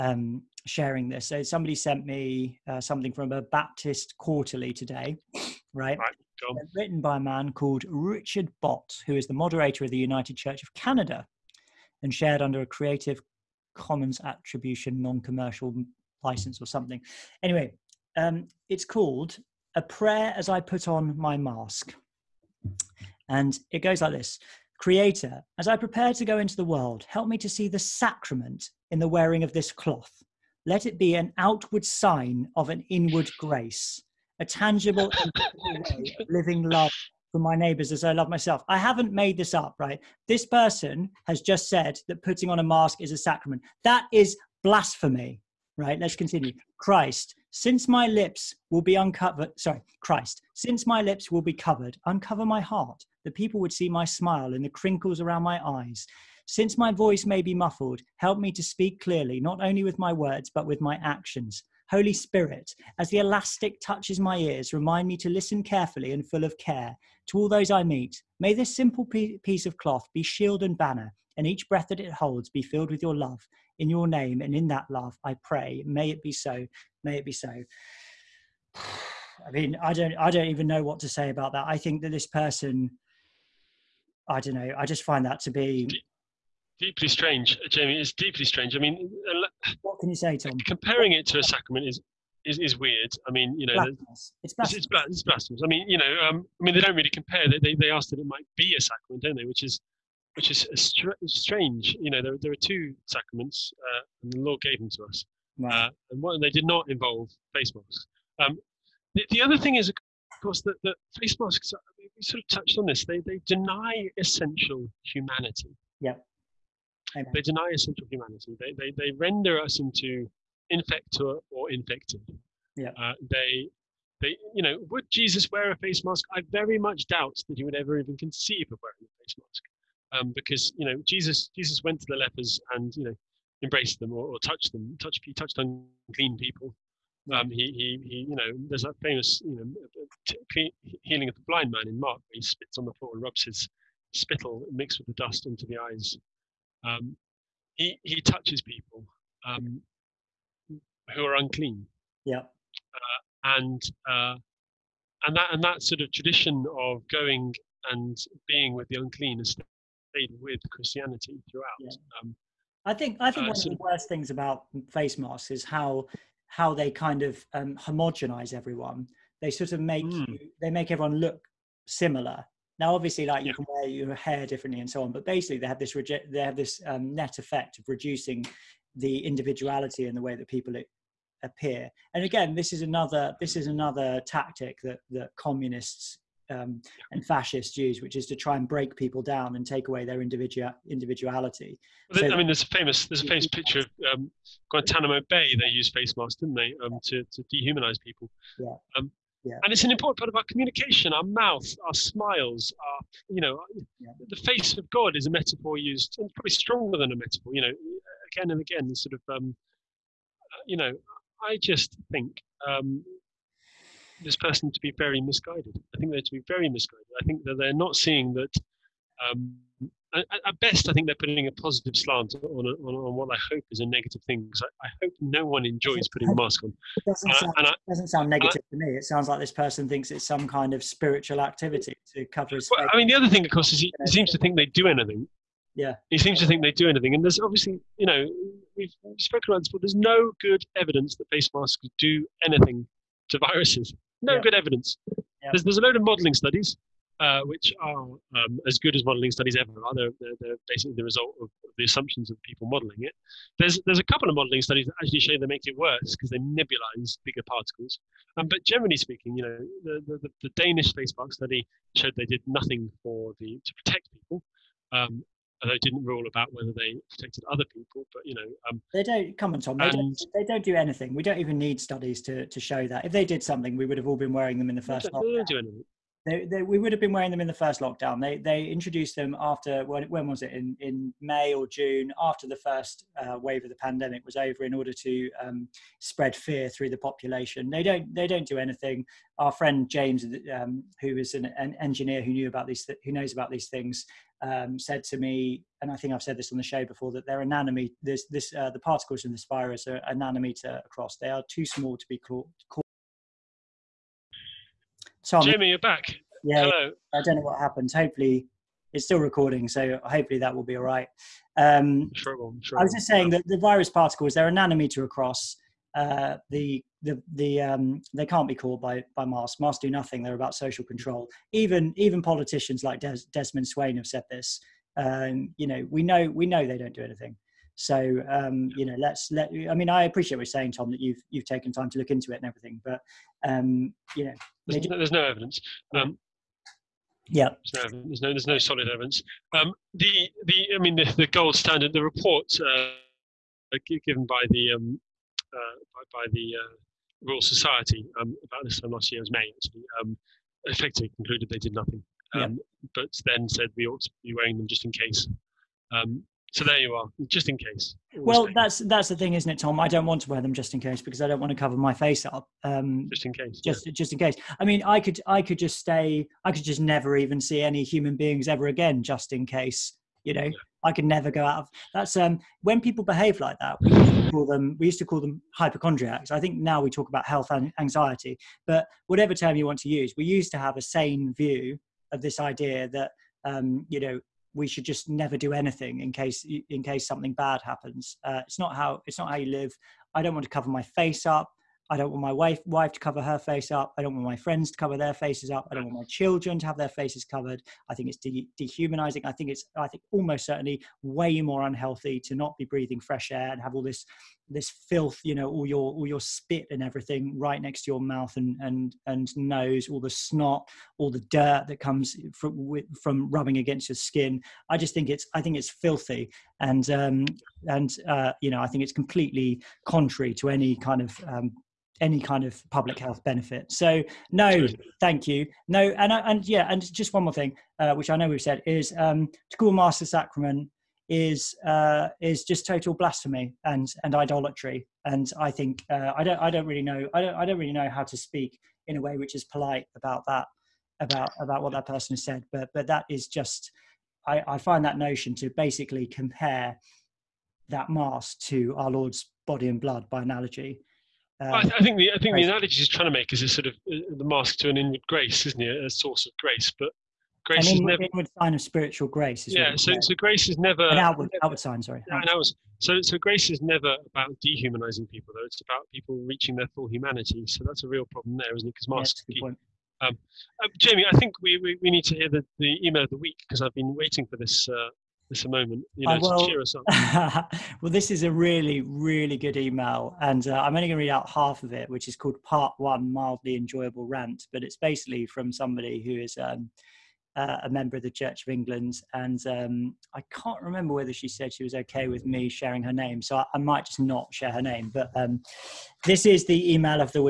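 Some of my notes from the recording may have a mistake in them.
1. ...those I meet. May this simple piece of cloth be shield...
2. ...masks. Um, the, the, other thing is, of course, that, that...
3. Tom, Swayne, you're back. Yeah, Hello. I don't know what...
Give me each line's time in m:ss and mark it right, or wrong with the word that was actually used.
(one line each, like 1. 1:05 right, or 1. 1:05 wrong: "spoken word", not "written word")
1. 1:07 right
2. 1:47 right
3. 5:05 wrong: "Jimmy", not "Swayne".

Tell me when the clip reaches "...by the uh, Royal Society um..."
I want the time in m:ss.
5:46.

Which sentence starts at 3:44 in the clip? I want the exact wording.
Because I, I, hope no one enjoys putting a mask on.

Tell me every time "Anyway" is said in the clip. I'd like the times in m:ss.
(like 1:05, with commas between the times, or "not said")
0:17.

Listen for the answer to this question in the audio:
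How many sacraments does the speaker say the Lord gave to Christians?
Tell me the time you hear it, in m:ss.
1:42.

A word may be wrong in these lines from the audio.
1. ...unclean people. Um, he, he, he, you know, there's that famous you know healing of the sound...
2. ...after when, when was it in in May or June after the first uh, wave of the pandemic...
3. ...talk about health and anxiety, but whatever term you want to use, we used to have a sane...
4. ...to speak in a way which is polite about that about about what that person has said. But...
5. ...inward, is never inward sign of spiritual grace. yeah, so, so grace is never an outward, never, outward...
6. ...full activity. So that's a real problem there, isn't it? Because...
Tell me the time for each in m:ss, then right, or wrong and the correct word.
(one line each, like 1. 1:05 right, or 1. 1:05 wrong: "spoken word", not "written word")
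1. 2:15 wrong: "blind", not "sound"
2. 4:39 right
3. 6:16 right
4. 7:18 right
5. 7:37 right
6. 7:46 wrong: "humanity", not "activity".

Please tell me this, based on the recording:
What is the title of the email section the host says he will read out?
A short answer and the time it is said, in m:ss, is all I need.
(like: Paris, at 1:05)
Part One: Mildly Enjoyable Rant, at 8:02.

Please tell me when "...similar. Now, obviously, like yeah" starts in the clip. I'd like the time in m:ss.
2:51.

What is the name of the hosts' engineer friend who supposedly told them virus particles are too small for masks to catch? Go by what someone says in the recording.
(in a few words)
James.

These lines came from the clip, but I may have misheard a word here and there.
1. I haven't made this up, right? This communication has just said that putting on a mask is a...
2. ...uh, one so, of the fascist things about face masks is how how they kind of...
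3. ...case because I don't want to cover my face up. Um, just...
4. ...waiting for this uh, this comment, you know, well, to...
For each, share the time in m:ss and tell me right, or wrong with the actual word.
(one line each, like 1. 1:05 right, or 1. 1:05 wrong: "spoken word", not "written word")
1. 0:38 wrong: "person", not "communication"
2. 2:43 wrong: "worst", not "fascist"
3. 6:00 right
4. 7:53 wrong: "moment", not "comment".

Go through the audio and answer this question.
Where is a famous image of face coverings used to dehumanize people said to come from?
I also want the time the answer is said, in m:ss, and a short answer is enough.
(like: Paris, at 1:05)
Guantanamo Bay, at 3:14.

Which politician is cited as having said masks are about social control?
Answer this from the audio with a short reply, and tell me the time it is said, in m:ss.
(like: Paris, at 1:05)
Desmond Swayne, at 5:23.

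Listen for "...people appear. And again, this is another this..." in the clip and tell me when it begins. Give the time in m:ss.
3:00.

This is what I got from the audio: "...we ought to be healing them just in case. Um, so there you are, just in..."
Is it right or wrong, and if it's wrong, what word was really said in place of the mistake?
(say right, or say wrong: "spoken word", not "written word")
wrong: "wearing", not "healing".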